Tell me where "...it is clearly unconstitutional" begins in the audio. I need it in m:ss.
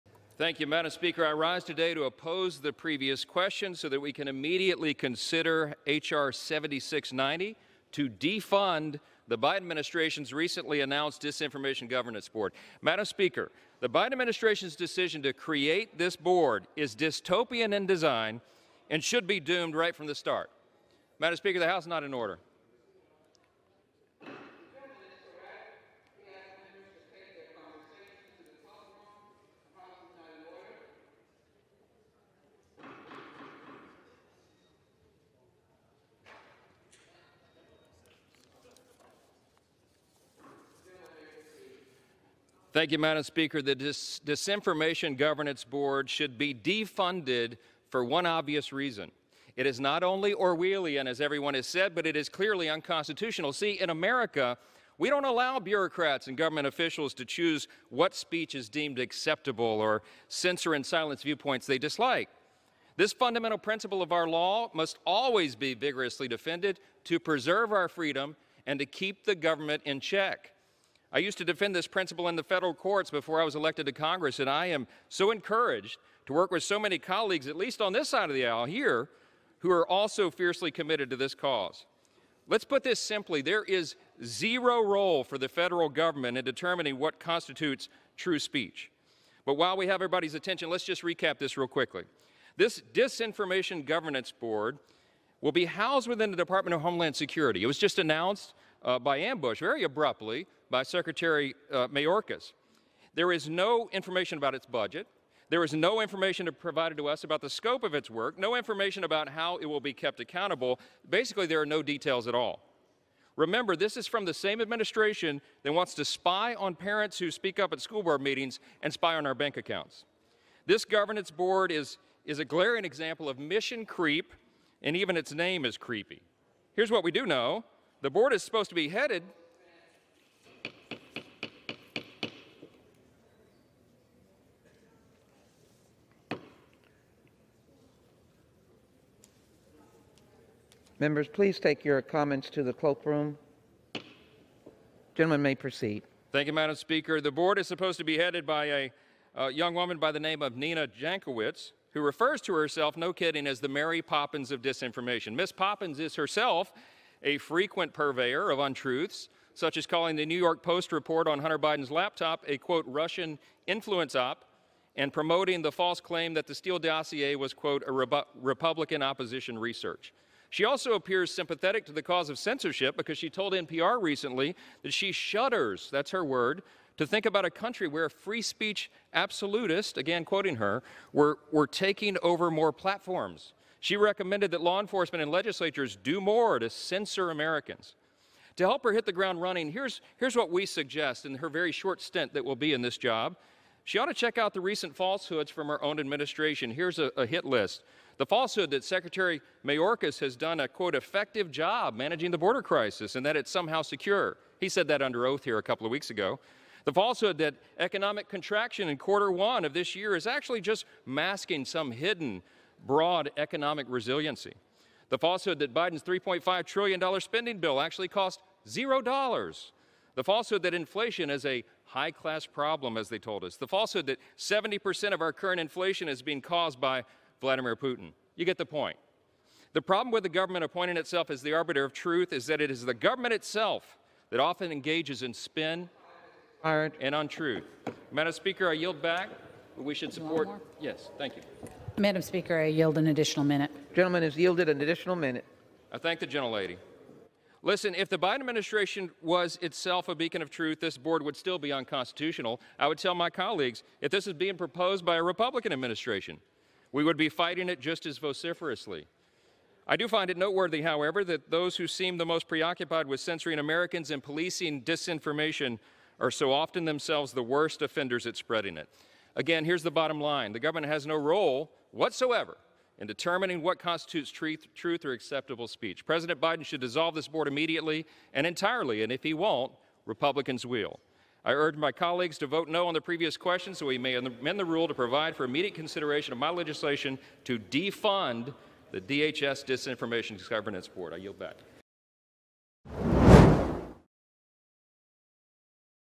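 0:52.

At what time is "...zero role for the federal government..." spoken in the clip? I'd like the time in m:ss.
1:24.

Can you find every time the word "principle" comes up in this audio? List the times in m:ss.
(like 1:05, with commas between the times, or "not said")
1:03, 1:11.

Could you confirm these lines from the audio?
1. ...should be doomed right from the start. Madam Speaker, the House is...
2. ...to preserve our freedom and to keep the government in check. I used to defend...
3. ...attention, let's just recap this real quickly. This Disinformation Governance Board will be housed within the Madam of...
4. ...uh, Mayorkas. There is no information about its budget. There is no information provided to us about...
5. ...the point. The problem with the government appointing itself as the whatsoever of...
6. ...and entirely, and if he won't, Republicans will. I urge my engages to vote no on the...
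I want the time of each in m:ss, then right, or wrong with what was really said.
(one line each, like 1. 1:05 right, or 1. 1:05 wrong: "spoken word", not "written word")
1. 0:19 right
2. 1:07 right
3. 1:30 wrong: "Department", not "Madam"
4. 1:41 right
5. 3:48 wrong: "arbiter", not "whatsoever"
6. 4:38 wrong: "colleagues", not "engages".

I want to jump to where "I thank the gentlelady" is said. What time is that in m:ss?
4:05.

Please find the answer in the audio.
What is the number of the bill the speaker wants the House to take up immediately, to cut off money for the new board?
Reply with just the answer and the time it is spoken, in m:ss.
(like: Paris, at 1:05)
H.R. 7690, at 0:05.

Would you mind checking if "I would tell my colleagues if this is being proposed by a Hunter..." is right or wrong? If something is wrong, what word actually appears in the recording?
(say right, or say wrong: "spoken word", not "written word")
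wrong: "Republican", not "Hunter".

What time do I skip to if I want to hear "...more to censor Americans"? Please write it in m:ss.
3:06.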